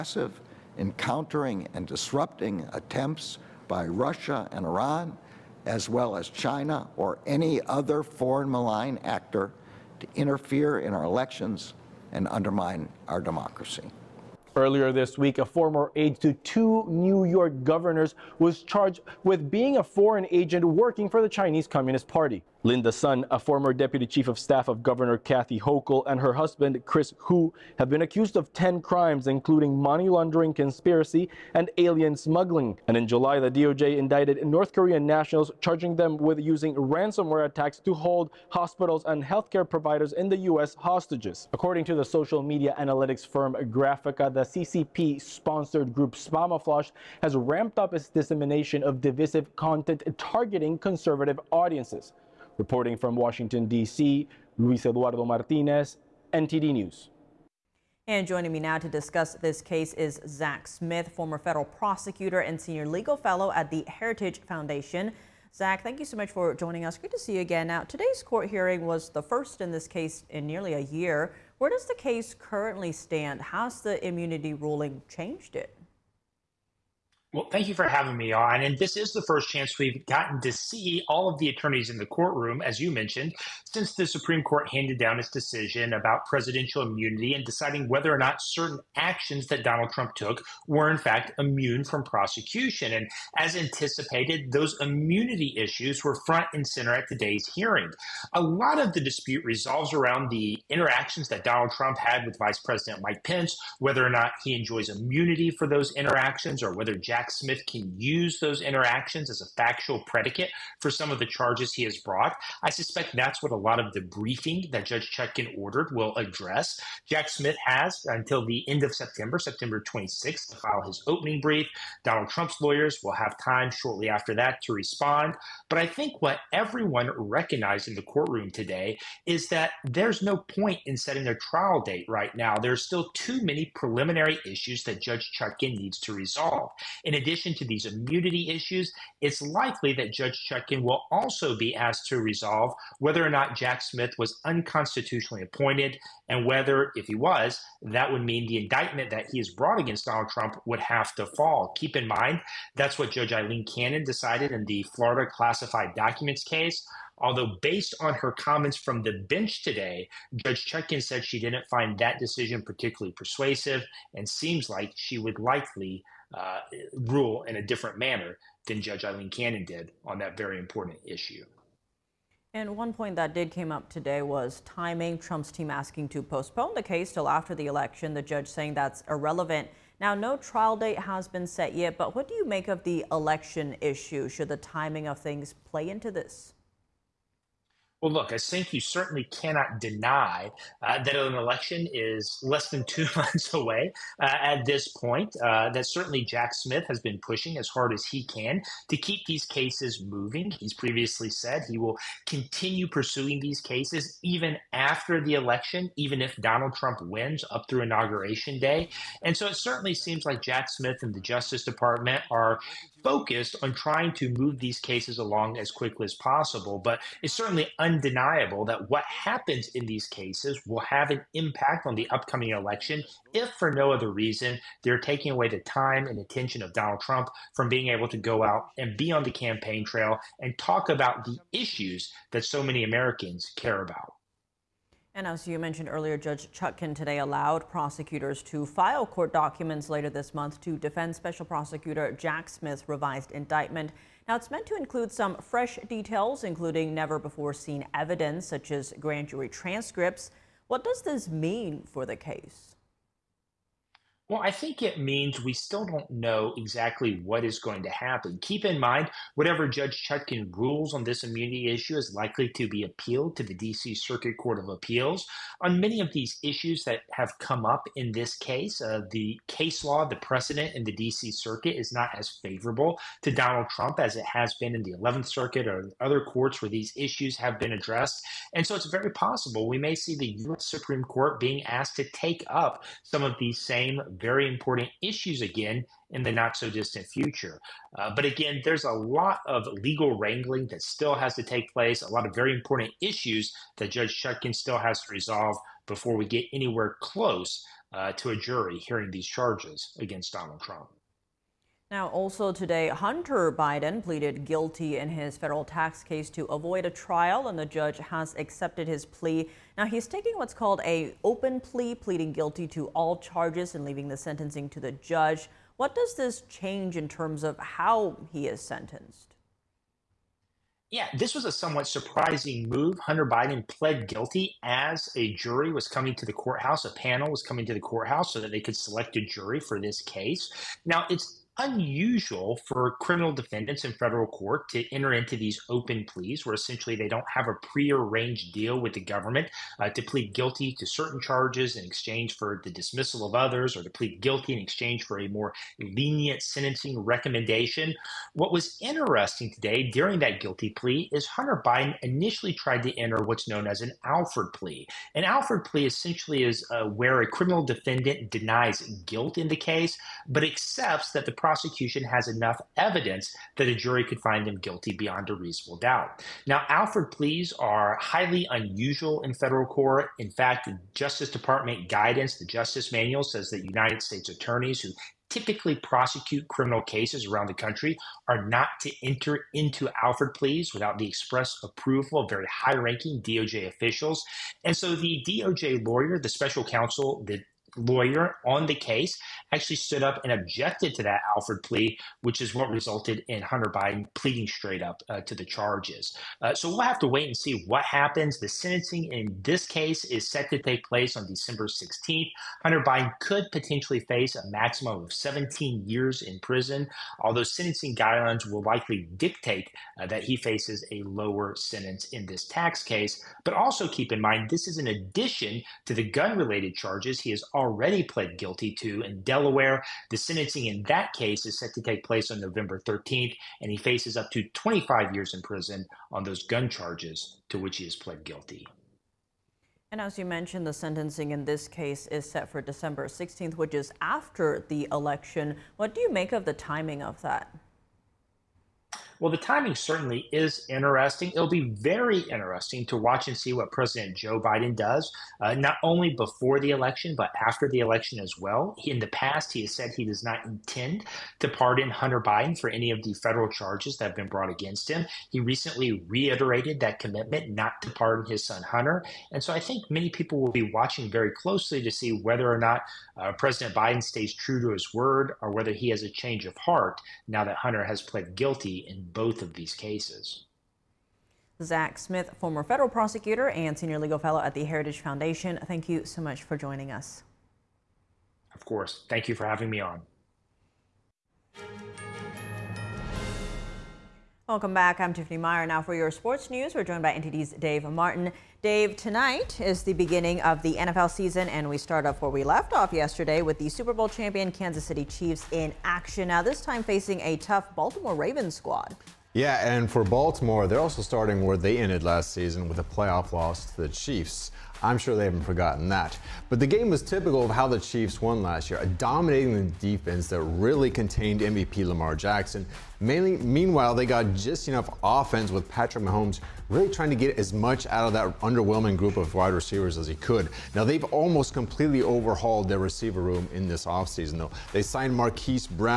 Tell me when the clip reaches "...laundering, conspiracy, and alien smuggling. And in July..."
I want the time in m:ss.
0:30.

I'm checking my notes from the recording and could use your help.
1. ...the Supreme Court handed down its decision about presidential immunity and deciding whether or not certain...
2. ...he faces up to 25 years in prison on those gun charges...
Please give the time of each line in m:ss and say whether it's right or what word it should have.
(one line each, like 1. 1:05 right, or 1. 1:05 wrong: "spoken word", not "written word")
1. 1:23 right
2. 7:03 right.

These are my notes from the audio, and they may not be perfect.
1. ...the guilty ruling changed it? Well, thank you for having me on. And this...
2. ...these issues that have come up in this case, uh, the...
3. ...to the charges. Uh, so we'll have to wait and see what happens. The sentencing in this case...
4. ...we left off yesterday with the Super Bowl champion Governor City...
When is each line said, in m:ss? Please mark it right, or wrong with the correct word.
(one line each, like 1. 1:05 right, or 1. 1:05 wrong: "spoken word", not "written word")
1. 1:13 wrong: "immunity", not "guilty"
2. 4:26 right
3. 6:35 right
4. 8:12 wrong: "Kansas", not "Governor".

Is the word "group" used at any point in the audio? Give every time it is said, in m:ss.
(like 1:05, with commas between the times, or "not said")
0:45, 8:38.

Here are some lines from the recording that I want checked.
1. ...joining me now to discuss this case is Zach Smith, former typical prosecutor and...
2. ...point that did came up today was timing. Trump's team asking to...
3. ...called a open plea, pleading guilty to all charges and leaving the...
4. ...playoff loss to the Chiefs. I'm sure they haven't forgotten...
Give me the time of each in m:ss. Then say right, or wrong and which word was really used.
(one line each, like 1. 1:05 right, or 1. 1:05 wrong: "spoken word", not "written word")
1. 0:58 wrong: "federal", not "typical"
2. 2:52 right
3. 5:10 right
4. 8:22 right.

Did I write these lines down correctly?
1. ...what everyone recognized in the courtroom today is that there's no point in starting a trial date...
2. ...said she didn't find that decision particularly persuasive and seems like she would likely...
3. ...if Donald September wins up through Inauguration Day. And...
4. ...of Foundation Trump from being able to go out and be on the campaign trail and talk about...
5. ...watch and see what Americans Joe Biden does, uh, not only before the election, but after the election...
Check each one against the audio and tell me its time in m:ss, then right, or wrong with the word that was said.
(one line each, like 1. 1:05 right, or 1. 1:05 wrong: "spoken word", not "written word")
1. 2:06 wrong: "setting", not "starting"
2. 2:41 right
3. 3:26 wrong: "Trump", not "September"
4. 3:46 wrong: "Donald", not "Foundation"
5. 7:22 wrong: "President", not "Americans".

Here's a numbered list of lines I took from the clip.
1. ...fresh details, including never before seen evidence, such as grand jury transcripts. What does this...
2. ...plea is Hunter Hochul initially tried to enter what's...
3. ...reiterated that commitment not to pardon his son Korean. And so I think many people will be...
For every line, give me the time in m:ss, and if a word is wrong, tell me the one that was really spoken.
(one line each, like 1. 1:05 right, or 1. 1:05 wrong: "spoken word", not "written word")
1. 4:05 right
2. 5:50 wrong: "Biden", not "Hochul"
3. 7:36 wrong: "Hunter", not "Korean".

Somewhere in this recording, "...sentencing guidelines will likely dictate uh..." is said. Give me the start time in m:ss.
6:47.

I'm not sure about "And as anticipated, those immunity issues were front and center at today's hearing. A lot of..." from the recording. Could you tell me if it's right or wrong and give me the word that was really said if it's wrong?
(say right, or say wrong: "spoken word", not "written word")
right.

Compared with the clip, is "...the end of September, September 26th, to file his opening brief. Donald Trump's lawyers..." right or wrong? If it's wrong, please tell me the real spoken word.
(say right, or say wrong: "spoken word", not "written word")
right.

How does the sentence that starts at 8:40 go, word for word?
Now, they've almost completely overhauled their receiver room in this offseason, though.